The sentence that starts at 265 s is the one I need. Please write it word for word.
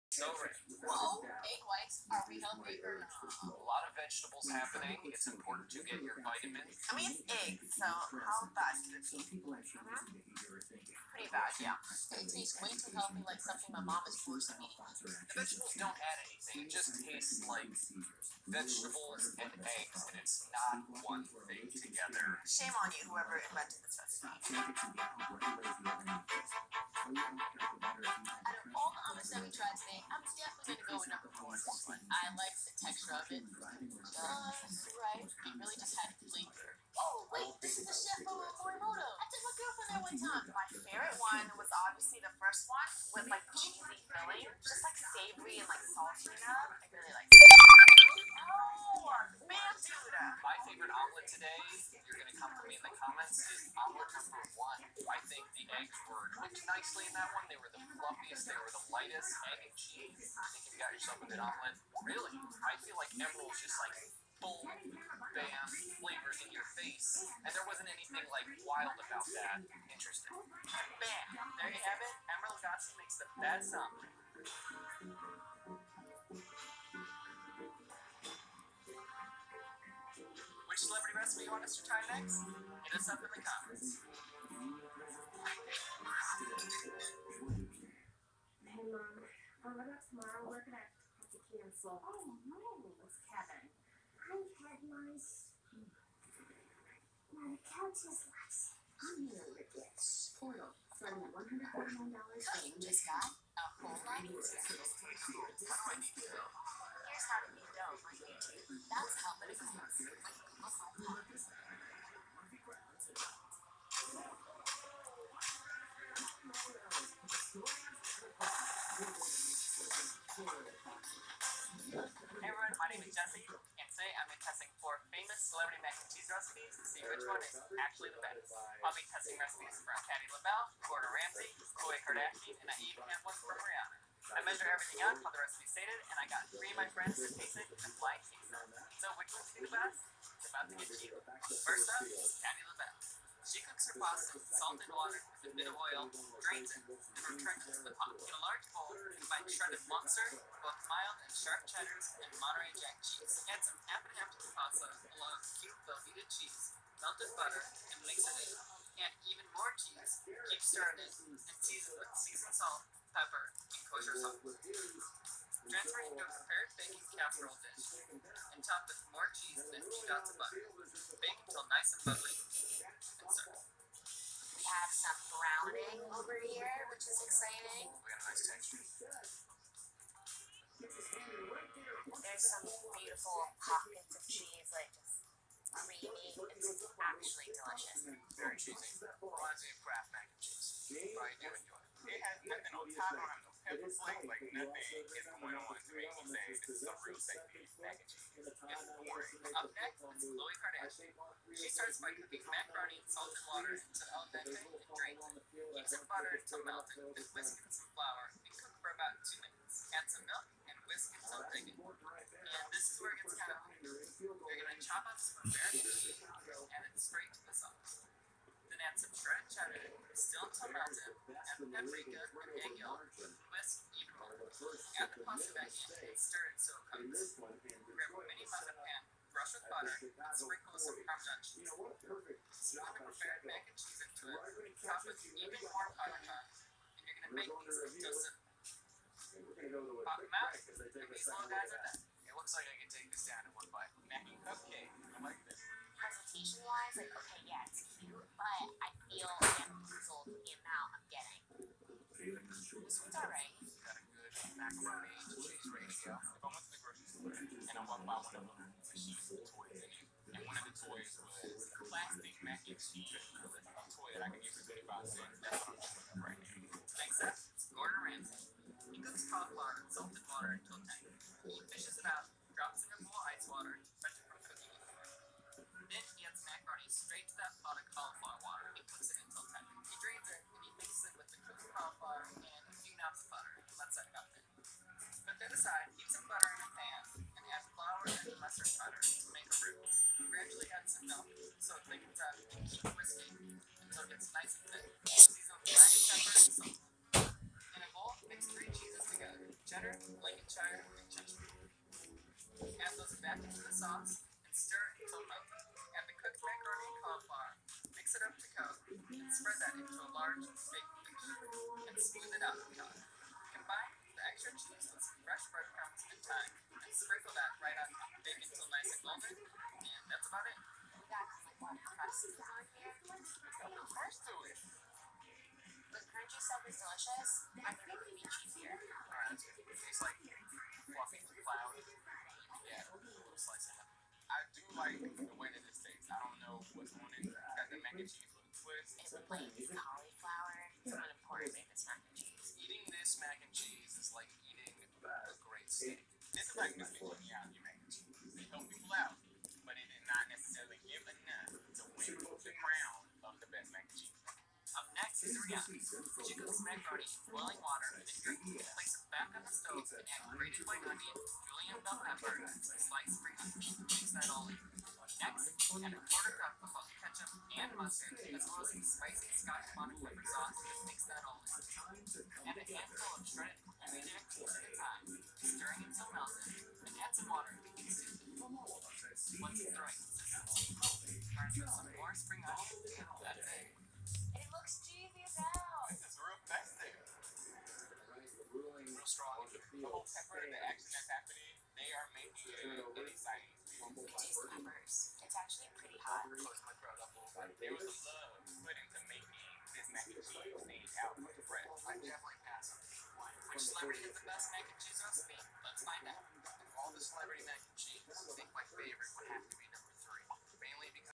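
That's what I'm doing right now.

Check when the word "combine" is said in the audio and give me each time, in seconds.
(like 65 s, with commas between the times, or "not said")
148 s, 313 s.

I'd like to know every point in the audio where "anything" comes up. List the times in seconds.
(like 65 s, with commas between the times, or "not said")
16 s, 67 s.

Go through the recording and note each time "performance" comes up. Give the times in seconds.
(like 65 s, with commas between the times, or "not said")
not said.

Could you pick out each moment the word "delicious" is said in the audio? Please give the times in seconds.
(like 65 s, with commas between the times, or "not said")
187 s, 326 s.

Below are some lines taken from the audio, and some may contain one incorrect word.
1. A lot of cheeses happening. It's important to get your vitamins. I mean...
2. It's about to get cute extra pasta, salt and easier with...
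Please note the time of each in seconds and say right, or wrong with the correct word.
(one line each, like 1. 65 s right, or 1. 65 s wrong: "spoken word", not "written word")
1. 3 s wrong: "vegetables", not "cheeses"
2. 140 s wrong: "water", not "easier".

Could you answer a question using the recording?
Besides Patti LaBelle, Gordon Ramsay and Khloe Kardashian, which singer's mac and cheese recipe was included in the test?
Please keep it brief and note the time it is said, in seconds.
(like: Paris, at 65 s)
Rihanna, at 133 s.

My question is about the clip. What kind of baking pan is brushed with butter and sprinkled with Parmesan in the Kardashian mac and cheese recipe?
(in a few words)
mini muffin pan.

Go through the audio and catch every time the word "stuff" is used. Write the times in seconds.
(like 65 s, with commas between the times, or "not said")
258 s, 326 s.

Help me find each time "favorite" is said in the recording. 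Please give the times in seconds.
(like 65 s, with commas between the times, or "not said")
40 s, 50 s.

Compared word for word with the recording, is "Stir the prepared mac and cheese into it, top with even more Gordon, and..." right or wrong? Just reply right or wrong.
wrong.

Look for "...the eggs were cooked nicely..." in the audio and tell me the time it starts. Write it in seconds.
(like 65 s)
55 s.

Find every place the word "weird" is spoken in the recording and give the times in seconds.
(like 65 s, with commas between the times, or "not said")
213 s.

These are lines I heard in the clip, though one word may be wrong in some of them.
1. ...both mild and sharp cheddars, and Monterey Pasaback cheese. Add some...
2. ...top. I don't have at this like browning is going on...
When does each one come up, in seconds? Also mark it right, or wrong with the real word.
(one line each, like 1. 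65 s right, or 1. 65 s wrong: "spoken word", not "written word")
1. 150 s wrong: "Jack", not "Pasaback"
2. 192 s wrong: "nothing", not "browning".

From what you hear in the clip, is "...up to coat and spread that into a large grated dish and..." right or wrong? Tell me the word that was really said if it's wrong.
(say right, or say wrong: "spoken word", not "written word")
wrong: "baked", not "grated".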